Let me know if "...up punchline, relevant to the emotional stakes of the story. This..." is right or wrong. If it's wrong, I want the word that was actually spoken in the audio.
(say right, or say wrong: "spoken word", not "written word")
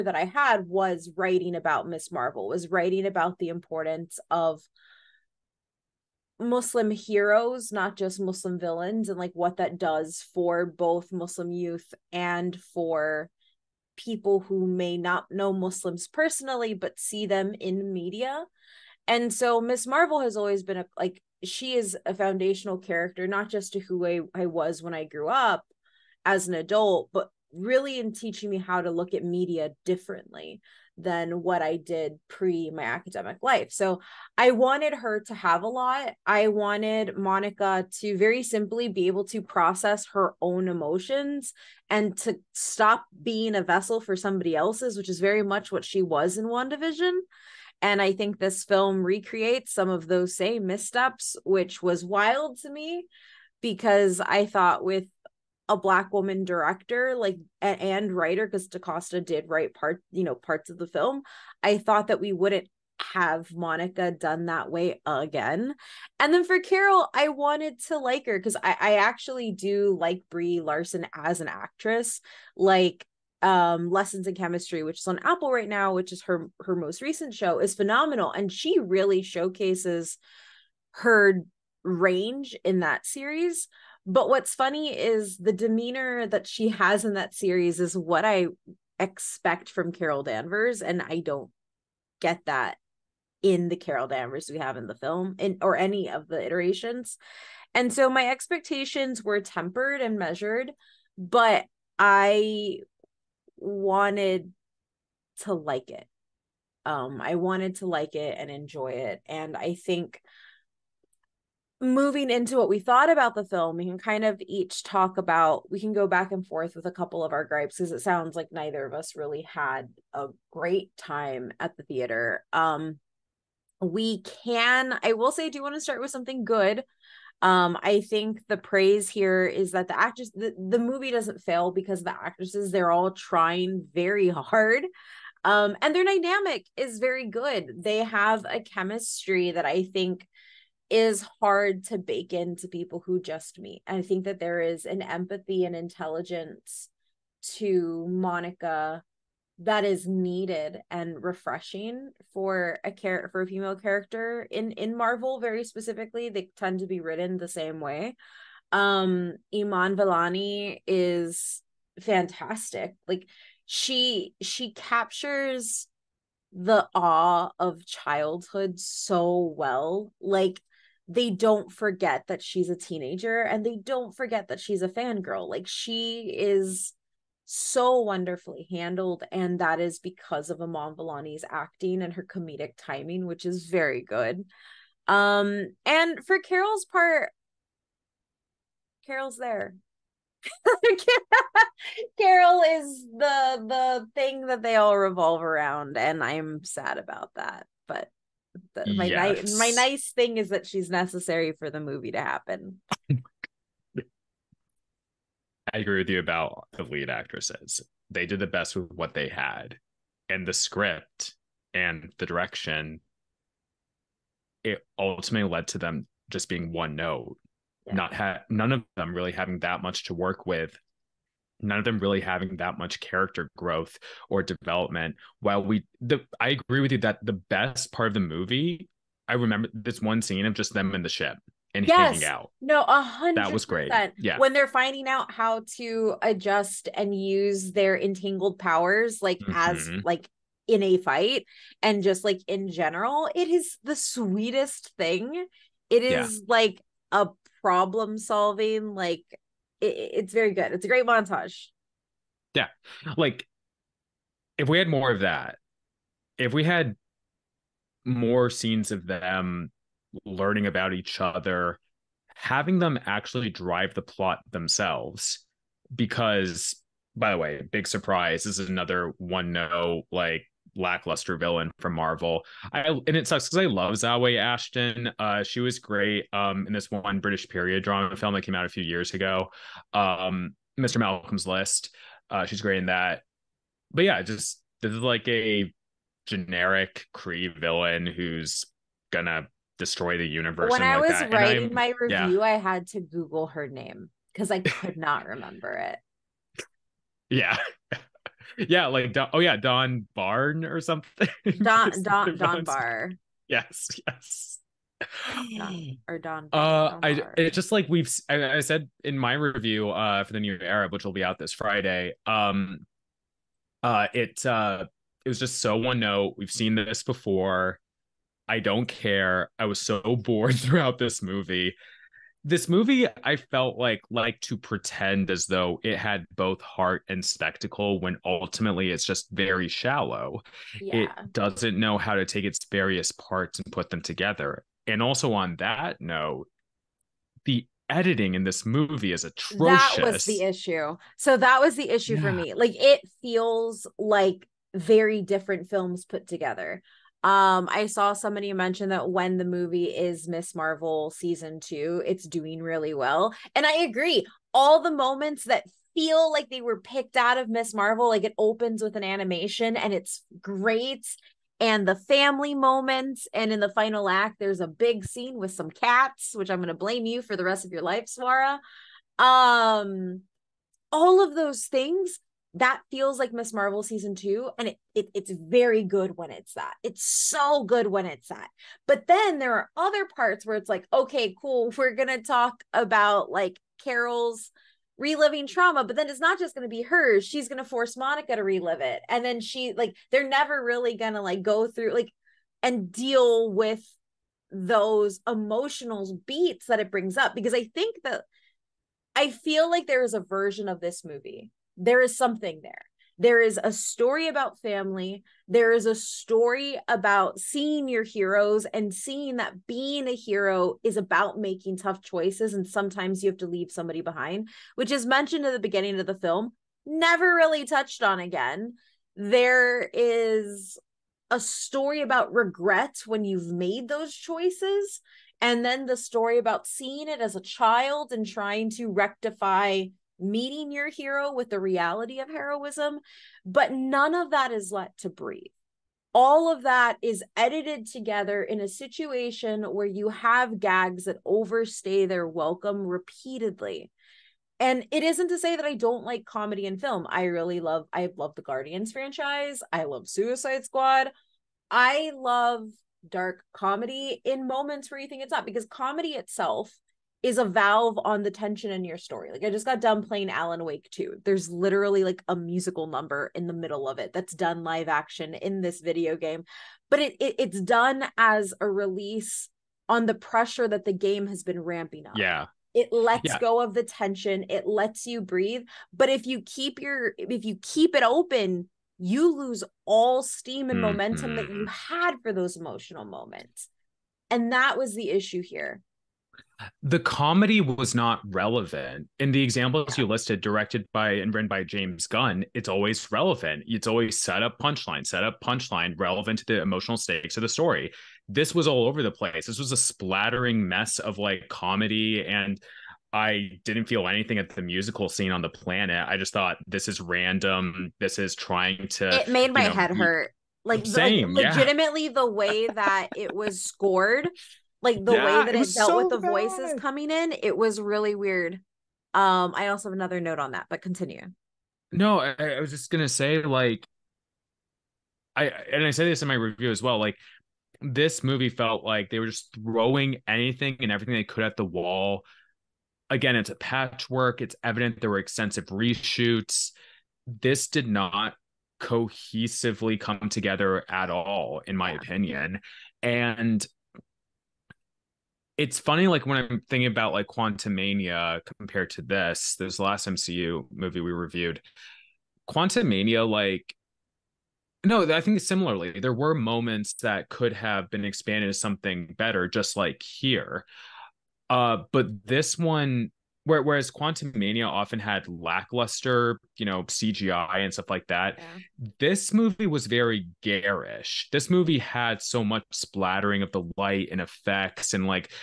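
right.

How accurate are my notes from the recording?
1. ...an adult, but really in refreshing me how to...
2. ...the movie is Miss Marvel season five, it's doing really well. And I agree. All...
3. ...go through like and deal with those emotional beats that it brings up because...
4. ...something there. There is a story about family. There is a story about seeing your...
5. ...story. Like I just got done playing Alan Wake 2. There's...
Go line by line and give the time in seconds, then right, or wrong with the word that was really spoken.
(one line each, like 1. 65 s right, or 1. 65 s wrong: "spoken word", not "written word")
1. 26 s wrong: "teaching", not "refreshing"
2. 349 s wrong: "two", not "five"
3. 391 s right
4. 402 s right
5. 458 s right.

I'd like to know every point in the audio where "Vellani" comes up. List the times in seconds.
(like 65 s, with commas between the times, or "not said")
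159 s, 180 s.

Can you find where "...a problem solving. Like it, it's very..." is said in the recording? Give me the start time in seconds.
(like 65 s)
247 s.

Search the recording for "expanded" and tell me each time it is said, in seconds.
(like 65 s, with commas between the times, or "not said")
558 s.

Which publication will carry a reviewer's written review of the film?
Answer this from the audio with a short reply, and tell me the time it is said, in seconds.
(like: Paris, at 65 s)
The New Arab, at 310 s.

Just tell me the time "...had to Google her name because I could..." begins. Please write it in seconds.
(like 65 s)
292 s.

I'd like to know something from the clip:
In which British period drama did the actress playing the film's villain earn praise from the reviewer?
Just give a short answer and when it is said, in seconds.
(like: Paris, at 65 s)
Mr. Malcolm's List, at 280 s.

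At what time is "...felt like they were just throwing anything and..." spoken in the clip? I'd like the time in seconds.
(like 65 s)
528 s.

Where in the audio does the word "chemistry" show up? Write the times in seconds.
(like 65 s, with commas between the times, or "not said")
74 s, 138 s.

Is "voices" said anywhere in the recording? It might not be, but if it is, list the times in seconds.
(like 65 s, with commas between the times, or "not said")
516 s.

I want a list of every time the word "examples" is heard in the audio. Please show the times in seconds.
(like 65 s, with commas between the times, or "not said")
489 s.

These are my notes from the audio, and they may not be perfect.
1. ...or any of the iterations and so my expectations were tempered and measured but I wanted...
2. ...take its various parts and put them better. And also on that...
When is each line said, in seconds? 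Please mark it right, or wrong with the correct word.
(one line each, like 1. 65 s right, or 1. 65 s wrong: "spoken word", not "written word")
1. 95 s right
2. 332 s wrong: "together", not "better".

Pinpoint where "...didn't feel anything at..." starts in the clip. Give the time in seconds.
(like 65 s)
503 s.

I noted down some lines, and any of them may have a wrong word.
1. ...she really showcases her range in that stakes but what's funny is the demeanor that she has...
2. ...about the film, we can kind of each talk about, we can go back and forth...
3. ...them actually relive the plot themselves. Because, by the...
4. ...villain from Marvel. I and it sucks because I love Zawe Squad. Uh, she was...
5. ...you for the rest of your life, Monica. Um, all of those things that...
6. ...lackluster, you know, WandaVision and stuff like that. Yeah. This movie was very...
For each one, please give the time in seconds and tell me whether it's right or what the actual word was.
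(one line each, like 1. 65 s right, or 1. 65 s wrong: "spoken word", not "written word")
1. 78 s wrong: "series", not "stakes"
2. 113 s right
3. 262 s wrong: "drive", not "relive"
4. 271 s wrong: "Ashton", not "Squad"
5. 367 s wrong: "Swara", not "Monica"
6. 565 s wrong: "CGI", not "WandaVision".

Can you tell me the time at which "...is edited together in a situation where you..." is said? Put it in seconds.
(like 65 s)
437 s.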